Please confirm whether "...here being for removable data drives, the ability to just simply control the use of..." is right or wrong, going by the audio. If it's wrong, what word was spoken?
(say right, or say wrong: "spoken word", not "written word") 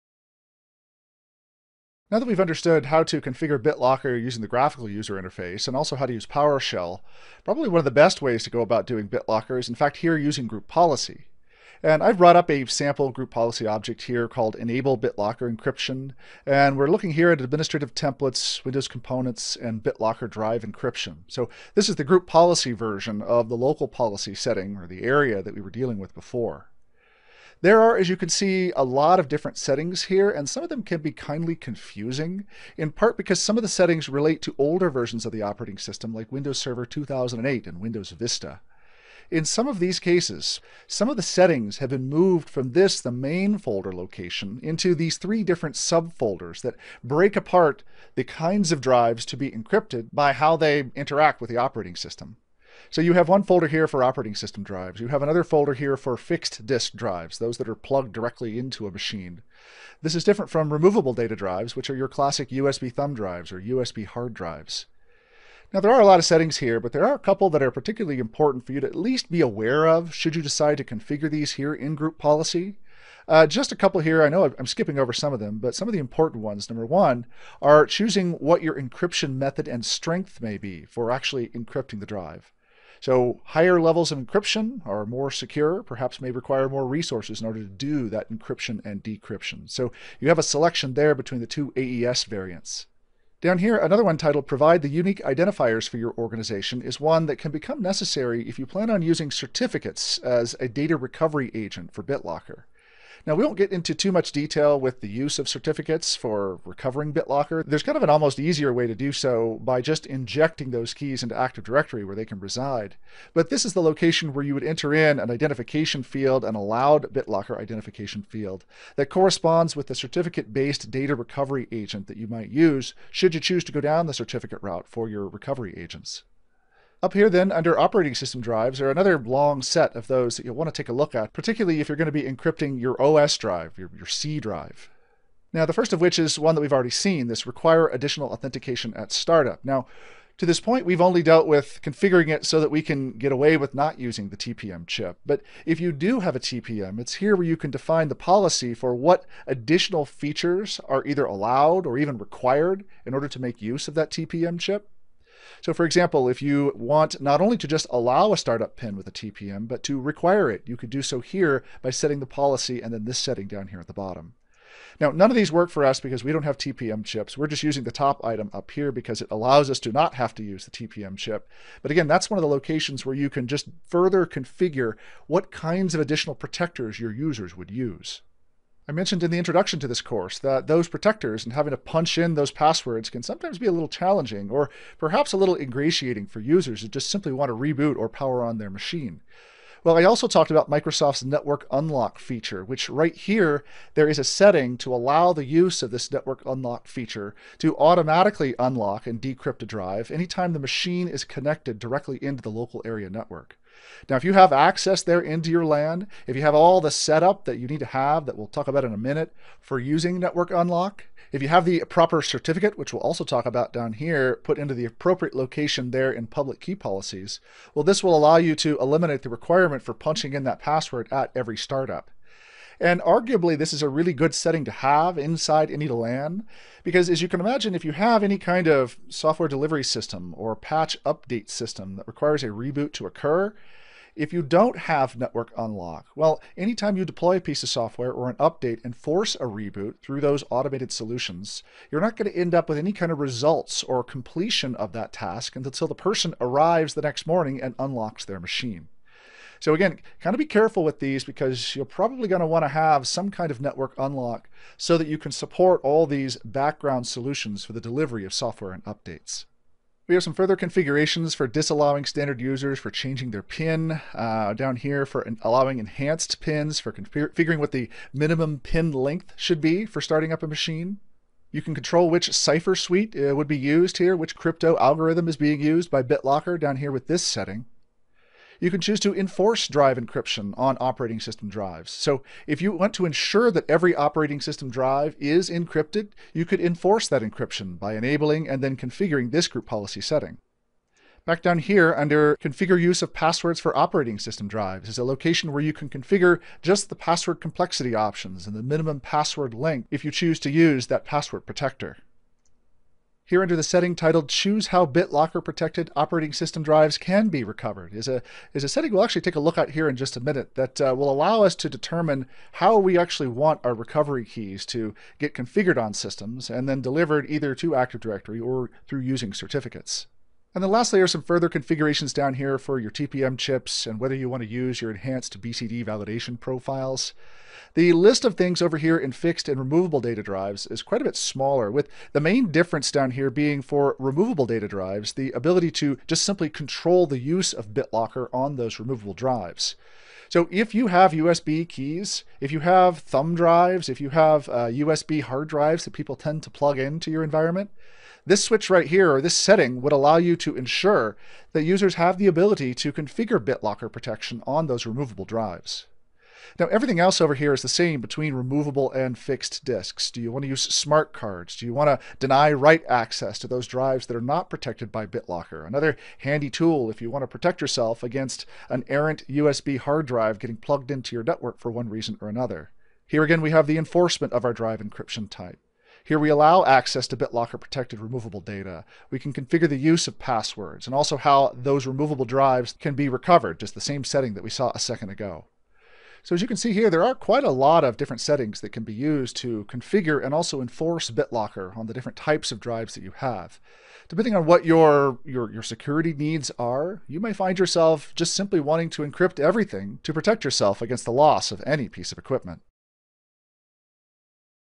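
right.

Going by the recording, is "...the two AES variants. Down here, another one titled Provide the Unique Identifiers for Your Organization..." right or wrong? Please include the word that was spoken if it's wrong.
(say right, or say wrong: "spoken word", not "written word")
right.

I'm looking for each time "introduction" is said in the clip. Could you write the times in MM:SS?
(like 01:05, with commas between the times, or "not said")
02:59.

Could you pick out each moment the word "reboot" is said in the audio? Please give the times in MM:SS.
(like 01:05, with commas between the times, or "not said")
03:07, 03:52, 03:59.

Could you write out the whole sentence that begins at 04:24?
Uh, down here for allowing enhanced PINs for configuring figuring what the minimum PIN length should be for starting up a machine.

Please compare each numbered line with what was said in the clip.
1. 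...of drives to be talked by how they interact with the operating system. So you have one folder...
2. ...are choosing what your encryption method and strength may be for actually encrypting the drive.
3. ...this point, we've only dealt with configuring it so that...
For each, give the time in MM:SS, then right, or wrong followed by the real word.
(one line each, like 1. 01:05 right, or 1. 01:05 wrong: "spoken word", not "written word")
1. 00:48 wrong: "encrypted", not "talked"
2. 01:17 right
3. 02:20 right.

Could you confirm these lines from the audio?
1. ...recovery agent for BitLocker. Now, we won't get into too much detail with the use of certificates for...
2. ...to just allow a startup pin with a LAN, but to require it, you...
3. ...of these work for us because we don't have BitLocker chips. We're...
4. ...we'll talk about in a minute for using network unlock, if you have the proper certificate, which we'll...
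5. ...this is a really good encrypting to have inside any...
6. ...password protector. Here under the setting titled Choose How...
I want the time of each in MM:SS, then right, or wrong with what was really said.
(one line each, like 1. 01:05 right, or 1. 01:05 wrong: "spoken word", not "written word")
1. 01:40 right
2. 02:37 wrong: "TPM", not "LAN"
3. 02:45 wrong: "TPM", not "BitLocker"
4. 03:28 right
5. 03:43 wrong: "setting", not "encrypting"
6. 05:01 right.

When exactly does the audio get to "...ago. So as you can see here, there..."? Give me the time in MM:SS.
06:25.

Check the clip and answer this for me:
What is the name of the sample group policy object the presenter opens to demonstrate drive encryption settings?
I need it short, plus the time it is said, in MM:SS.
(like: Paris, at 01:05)
Enable BitLocker encryption, at 00:14.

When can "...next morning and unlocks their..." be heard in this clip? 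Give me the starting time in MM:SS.
04:07.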